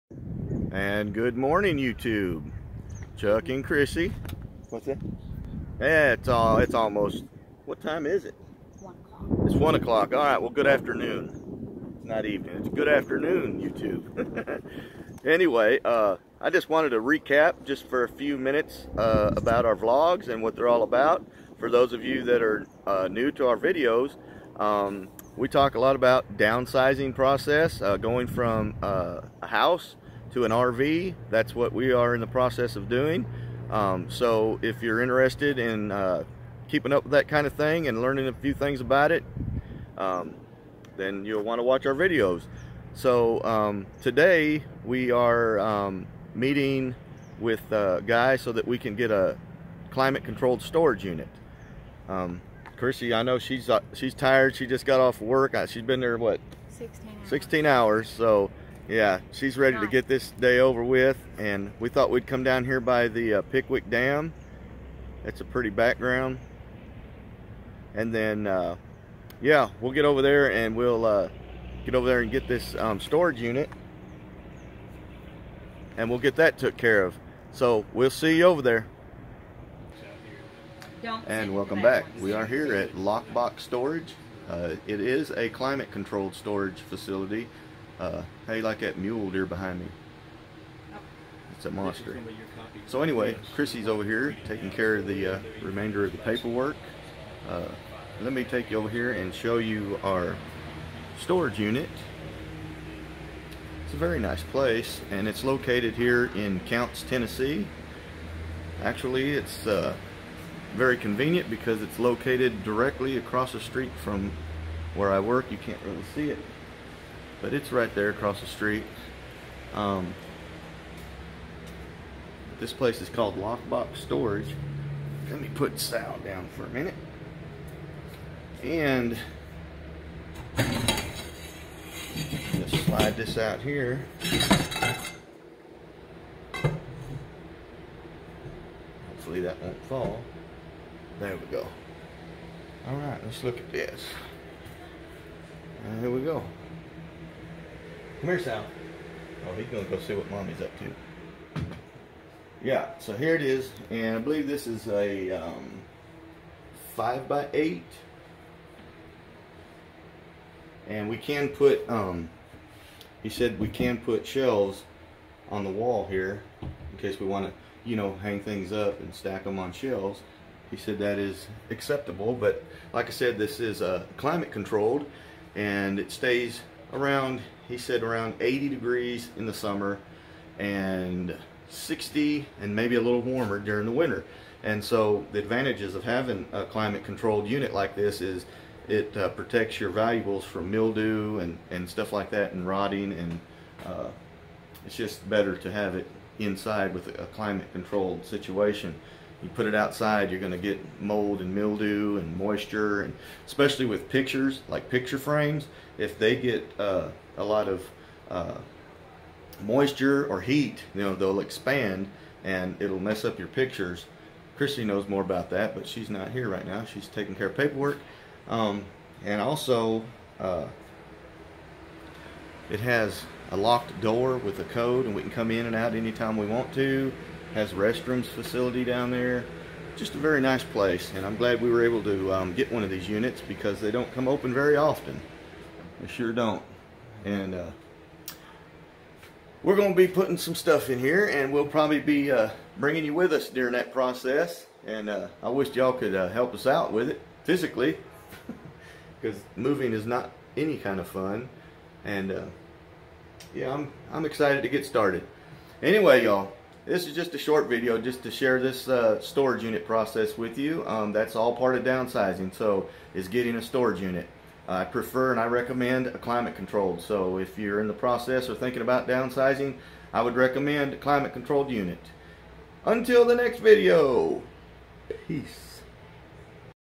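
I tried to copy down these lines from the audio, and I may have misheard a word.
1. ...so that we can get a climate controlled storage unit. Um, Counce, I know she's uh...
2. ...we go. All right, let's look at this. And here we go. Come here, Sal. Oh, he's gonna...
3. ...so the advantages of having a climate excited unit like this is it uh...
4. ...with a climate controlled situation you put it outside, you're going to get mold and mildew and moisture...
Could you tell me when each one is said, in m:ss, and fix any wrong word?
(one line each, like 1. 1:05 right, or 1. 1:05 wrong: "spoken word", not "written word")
1. 0:48 wrong: "Krissie", not "Counce"
2. 2:21 right
3. 3:04 wrong: "controlled", not "excited"
4. 3:16 right.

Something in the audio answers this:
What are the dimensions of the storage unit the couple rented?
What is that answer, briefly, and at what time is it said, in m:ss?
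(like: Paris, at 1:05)
5 by 8, at 2:36.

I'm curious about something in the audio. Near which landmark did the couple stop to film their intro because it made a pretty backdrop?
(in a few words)
Pickwick Dam.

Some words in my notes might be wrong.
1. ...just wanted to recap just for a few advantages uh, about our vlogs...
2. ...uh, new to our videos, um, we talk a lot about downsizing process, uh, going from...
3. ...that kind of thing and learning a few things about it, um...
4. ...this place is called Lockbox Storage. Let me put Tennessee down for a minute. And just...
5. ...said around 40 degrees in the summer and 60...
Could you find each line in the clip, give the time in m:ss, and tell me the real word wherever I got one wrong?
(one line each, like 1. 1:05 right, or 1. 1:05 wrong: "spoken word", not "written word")
1. 0:16 wrong: "minutes", not "advantages"
2. 0:22 right
3. 0:37 right
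4. 2:02 wrong: "Sal", not "Tennessee"
5. 2:57 wrong: "80", not "40".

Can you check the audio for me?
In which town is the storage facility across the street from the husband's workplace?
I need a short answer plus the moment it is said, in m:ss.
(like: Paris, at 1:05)
Counce, Tennessee, at 1:46.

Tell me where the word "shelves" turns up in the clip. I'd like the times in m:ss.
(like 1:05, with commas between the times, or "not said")
2:44, 2:49.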